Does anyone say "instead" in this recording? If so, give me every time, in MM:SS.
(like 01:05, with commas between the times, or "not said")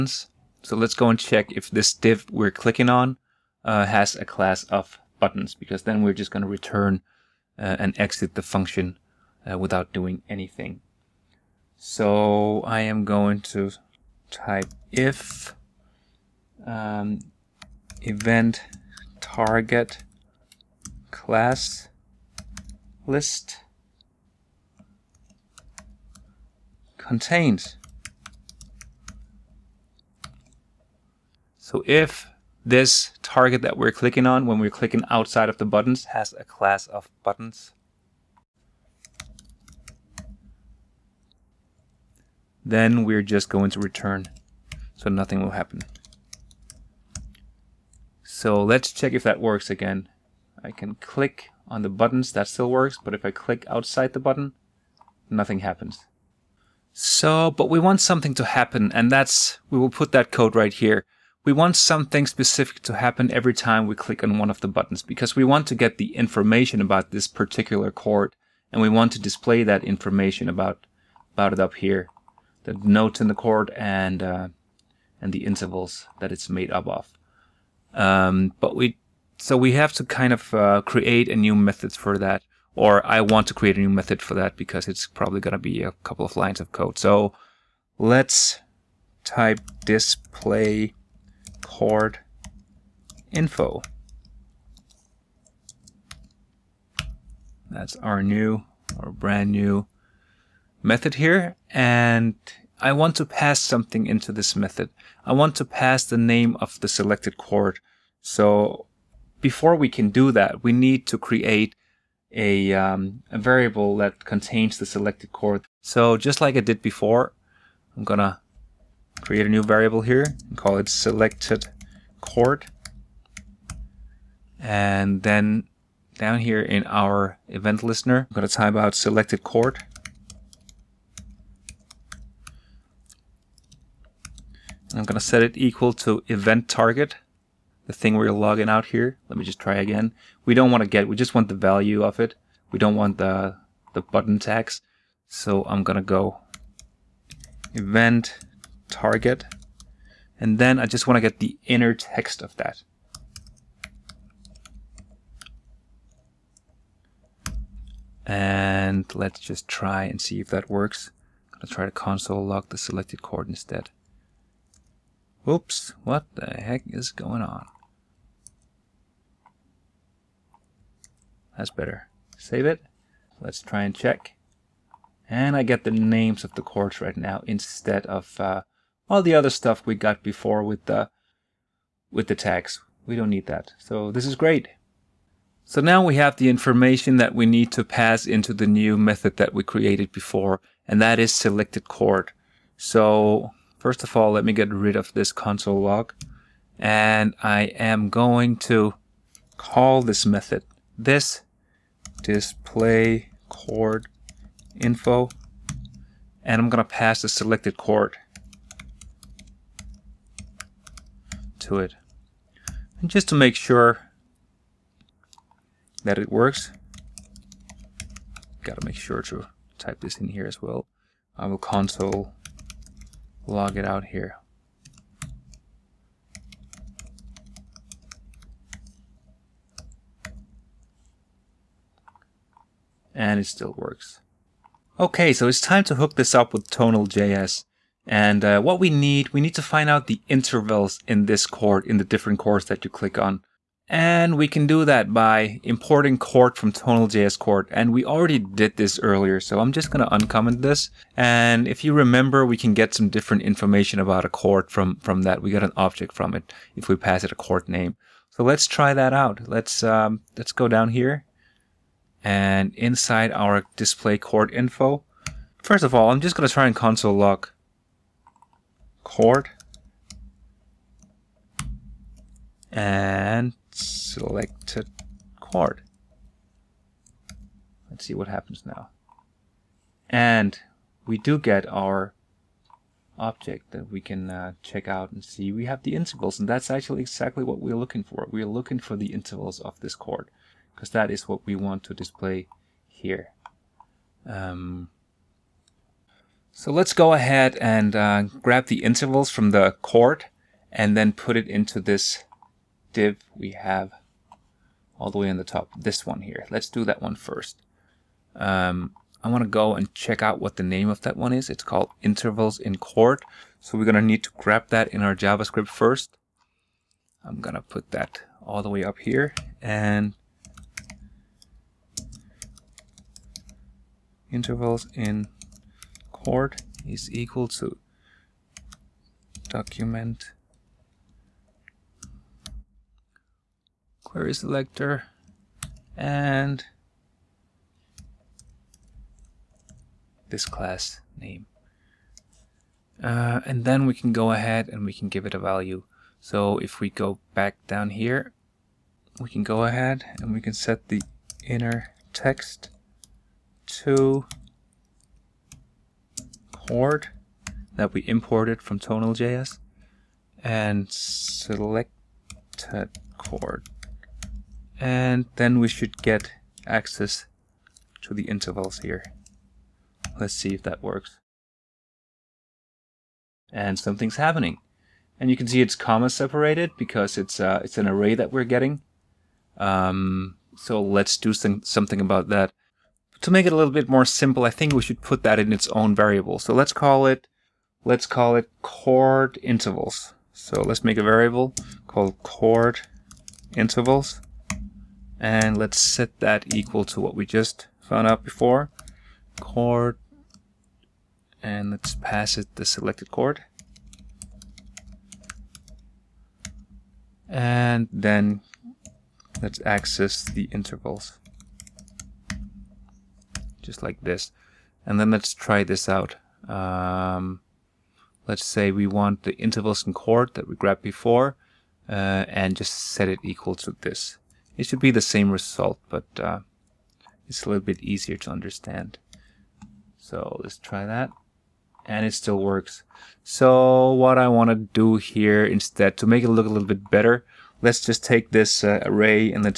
02:43, 02:57, 07:15.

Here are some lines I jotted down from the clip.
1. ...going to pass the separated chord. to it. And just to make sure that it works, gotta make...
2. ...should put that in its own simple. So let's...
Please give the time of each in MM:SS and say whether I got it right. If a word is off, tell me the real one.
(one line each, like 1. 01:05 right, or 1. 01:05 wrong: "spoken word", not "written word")
1. 03:26 wrong: "selected", not "separated"
2. 06:24 wrong: "variable", not "simple".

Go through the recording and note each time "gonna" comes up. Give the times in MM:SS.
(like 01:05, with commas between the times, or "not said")
01:25, 01:58, 02:25.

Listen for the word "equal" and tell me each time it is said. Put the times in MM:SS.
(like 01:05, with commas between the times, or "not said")
02:15, 05:27, 06:36, 07:03.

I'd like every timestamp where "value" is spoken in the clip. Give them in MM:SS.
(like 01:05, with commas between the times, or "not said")
02:21, 05:45.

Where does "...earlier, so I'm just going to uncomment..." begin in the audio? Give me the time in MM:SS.
04:08.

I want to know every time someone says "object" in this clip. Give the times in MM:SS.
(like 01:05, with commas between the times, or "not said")
04:15, 04:43.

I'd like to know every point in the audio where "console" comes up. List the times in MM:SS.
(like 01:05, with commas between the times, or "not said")
02:41, 03:15, 03:41, 04:26.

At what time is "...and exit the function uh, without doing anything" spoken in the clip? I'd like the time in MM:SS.
00:07.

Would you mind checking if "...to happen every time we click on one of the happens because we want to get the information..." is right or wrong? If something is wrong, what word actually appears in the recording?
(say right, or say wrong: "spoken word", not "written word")
wrong: "buttons", not "happens".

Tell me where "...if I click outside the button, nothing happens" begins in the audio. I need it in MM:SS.
00:53.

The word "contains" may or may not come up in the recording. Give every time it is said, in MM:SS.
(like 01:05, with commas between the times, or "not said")
00:26, 01:54.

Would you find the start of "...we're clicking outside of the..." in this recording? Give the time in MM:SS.
00:34.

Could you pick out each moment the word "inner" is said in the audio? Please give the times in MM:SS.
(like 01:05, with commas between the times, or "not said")
02:31, 05:51.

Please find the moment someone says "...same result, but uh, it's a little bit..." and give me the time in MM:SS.
07:05.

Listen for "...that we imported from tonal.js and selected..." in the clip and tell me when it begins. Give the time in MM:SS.
05:57.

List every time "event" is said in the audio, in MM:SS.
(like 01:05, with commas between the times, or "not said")
00:18, 02:07, 02:16, 02:27.